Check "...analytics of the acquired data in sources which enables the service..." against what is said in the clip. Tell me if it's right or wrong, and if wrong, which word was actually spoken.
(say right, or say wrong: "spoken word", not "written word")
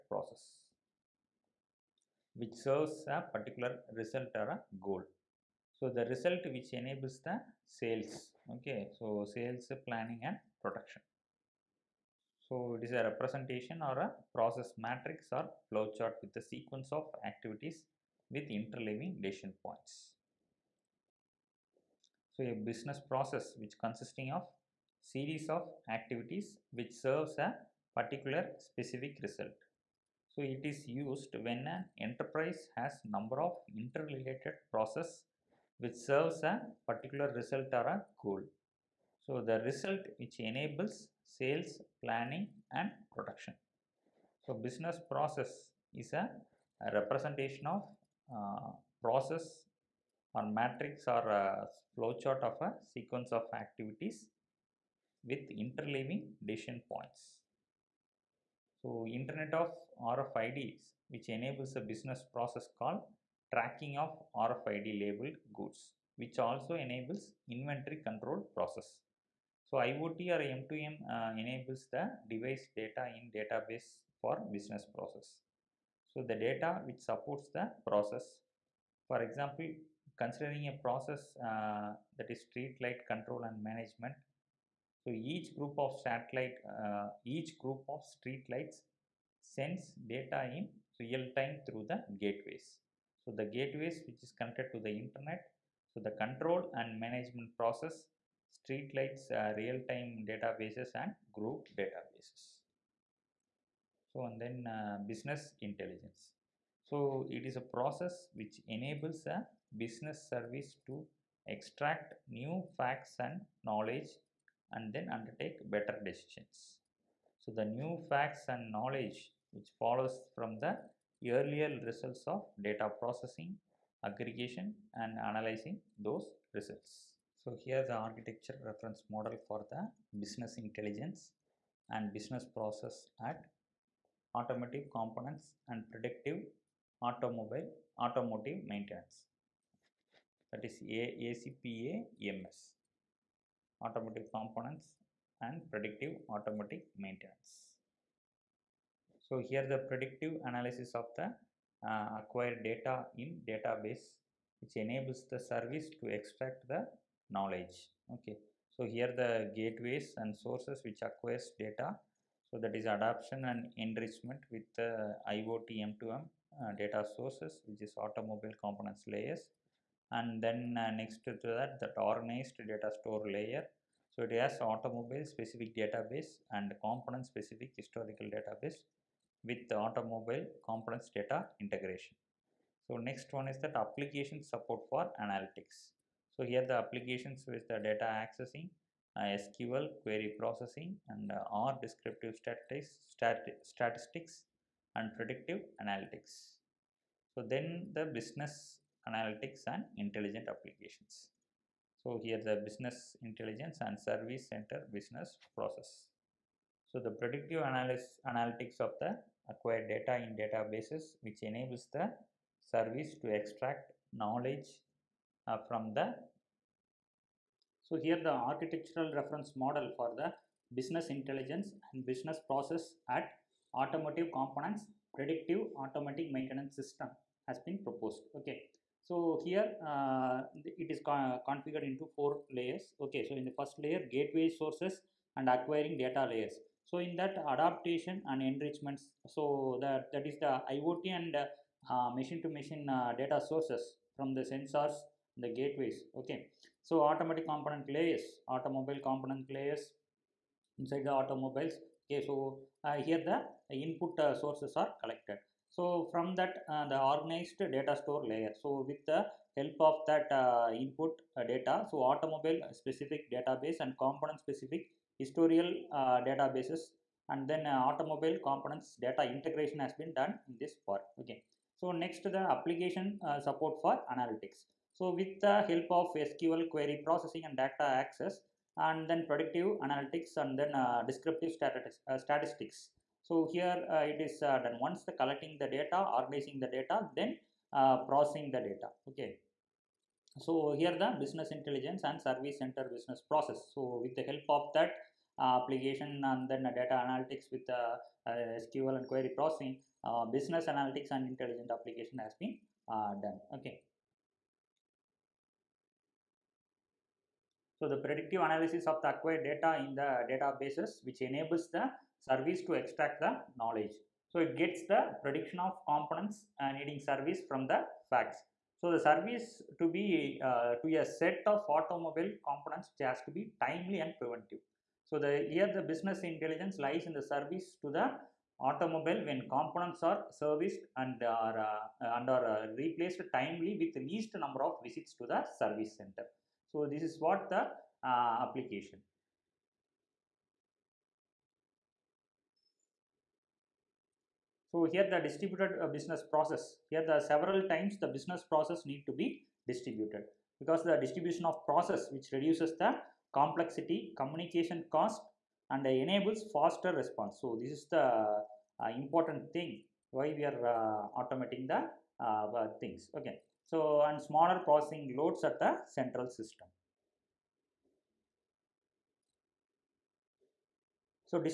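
wrong: "databases", not "sources".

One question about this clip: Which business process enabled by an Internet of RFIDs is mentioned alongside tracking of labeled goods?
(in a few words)
Inventory control.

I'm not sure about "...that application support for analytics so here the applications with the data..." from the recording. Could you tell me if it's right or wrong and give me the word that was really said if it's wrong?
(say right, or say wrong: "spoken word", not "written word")
right.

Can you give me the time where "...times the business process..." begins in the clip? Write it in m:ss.
5:47.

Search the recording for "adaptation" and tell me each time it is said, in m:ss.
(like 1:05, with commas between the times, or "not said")
3:57.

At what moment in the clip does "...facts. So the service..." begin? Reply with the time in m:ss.
5:18.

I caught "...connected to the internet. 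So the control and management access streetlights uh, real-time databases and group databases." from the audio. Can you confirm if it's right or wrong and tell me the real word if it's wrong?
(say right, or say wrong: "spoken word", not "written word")
wrong: "process", not "access".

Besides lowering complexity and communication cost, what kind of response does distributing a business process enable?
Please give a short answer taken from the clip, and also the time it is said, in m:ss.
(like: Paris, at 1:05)
Faster response, at 5:56.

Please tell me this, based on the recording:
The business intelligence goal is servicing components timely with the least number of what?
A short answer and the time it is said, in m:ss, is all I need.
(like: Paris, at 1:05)
Visits to the service center, at 5:34.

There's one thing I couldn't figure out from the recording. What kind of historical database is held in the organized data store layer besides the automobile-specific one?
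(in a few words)
Component specific historical database.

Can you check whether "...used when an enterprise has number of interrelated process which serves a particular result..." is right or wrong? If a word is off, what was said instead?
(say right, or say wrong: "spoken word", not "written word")
right.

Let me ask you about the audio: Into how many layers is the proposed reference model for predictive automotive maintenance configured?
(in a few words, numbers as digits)
4.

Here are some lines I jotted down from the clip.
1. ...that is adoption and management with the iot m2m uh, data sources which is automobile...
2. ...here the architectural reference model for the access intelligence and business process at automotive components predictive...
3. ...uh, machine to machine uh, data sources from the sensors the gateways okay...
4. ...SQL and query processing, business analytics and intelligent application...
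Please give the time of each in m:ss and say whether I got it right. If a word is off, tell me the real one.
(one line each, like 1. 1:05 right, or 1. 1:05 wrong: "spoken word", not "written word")
1. 2:42 wrong: "enrichment", not "management"
2. 3:38 wrong: "business", not "access"
3. 4:01 right
4. 4:58 right.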